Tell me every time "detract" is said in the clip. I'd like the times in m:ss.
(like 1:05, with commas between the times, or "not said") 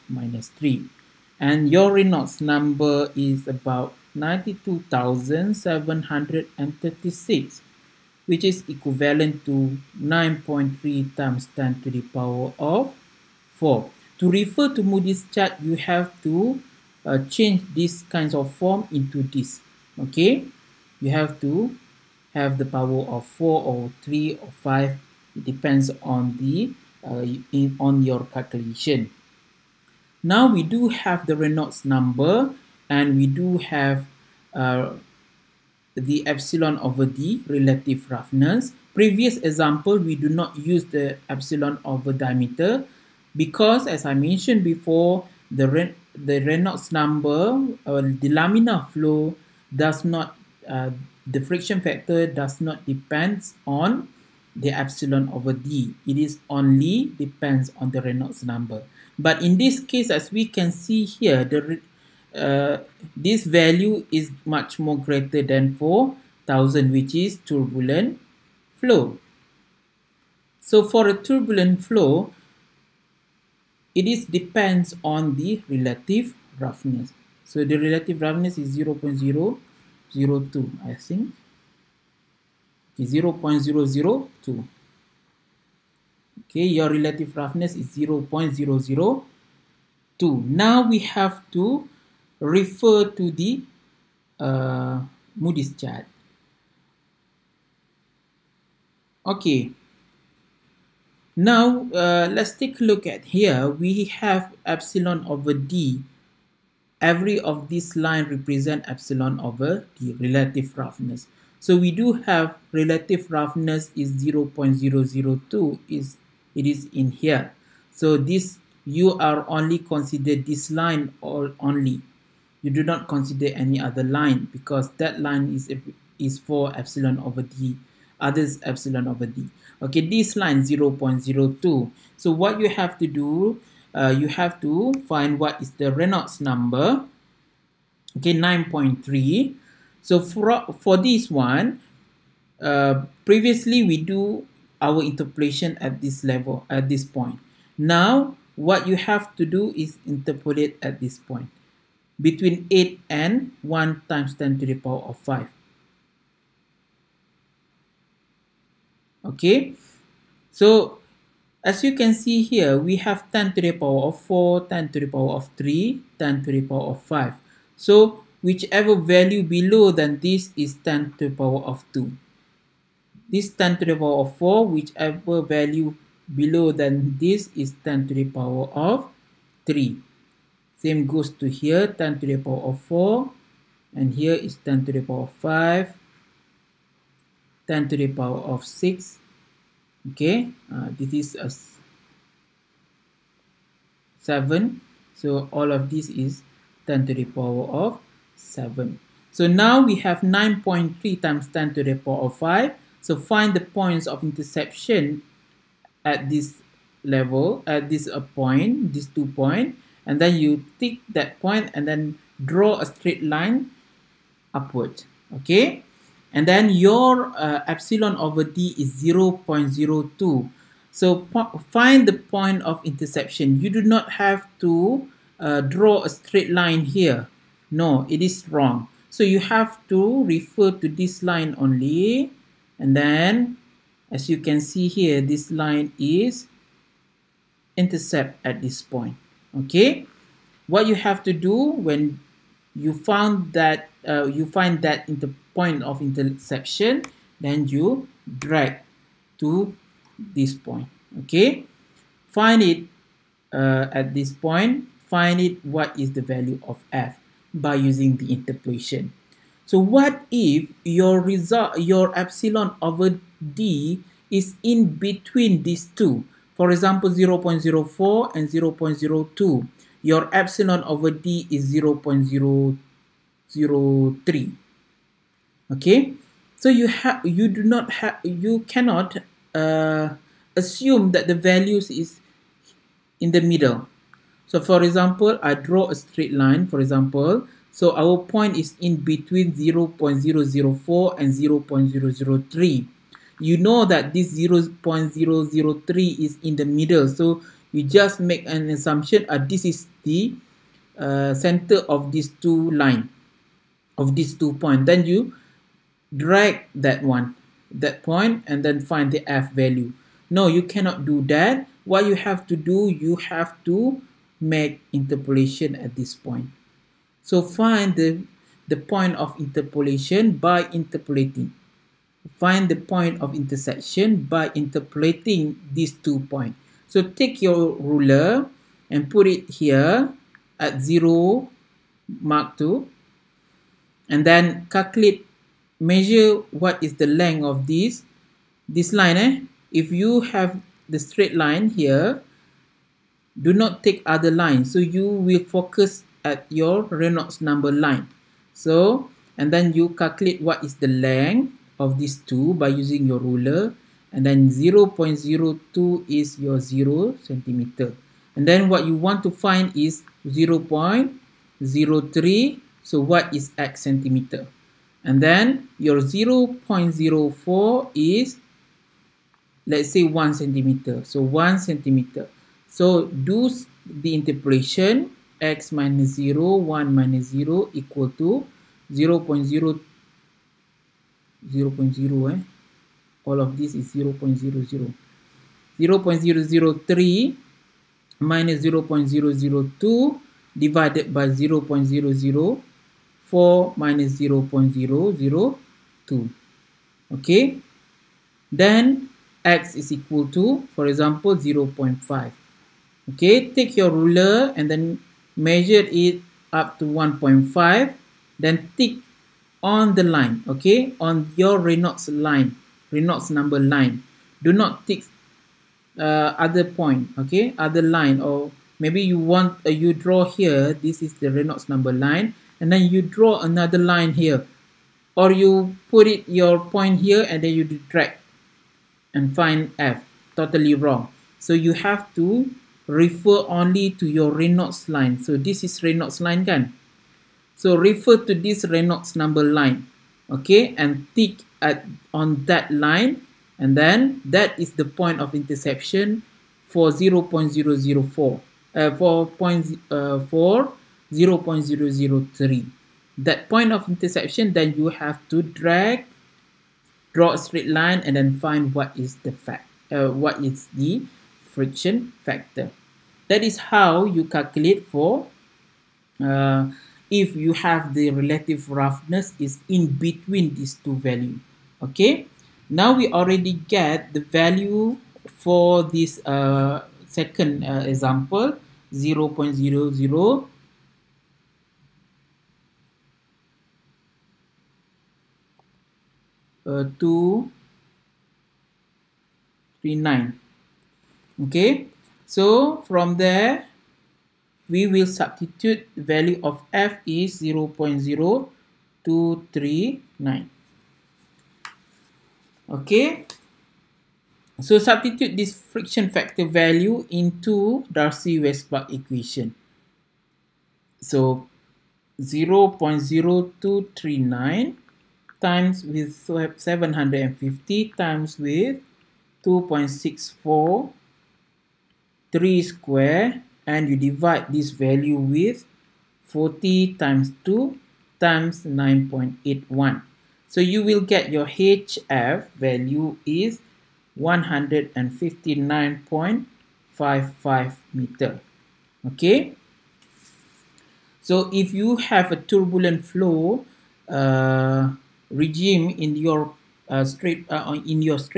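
7:07.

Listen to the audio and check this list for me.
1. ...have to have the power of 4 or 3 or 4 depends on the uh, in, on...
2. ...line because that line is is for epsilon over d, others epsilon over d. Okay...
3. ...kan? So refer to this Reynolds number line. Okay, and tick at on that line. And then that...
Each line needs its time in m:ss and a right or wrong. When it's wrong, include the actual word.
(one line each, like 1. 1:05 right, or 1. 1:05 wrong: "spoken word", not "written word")
1. 0:21 wrong: "5", not "4"
2. 2:04 right
3. 7:16 right.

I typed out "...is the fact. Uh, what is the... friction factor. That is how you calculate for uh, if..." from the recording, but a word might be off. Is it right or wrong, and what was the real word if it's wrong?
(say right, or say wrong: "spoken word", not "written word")
right.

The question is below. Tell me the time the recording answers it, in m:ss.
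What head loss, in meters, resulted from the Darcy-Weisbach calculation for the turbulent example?
8:54.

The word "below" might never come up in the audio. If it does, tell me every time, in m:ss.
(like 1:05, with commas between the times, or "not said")
2:49, 2:56.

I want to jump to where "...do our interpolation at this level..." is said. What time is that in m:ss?
2:23.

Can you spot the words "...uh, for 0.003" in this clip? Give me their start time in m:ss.
7:29.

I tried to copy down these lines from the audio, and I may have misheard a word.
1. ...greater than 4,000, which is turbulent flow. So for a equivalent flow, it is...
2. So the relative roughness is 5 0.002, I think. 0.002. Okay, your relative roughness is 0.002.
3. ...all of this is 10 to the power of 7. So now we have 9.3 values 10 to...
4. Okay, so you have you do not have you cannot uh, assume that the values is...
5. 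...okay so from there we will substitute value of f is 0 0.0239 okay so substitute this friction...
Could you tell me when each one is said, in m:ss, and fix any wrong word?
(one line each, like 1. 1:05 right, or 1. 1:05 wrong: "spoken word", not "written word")
1. 1:04 wrong: "turbulent", not "equivalent"
2. 1:17 wrong: "0", not "5"
3. 3:15 wrong: "times", not "values"
4. 4:35 right
5. 8:11 right.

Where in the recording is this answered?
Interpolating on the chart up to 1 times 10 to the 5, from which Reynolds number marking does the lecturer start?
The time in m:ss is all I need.
2:32.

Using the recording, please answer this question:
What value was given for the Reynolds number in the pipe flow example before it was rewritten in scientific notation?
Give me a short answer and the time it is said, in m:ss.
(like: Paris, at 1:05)
92,736, at 0:04.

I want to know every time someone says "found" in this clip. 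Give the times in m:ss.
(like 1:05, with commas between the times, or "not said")
4:02.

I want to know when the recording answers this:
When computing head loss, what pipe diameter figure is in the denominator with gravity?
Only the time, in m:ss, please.
8:46.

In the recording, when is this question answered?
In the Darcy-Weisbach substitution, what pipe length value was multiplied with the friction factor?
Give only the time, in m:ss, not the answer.
8:36.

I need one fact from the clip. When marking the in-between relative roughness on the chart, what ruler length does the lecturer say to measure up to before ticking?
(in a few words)
1.5.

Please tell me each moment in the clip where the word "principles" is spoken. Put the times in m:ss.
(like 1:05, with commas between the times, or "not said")
not said.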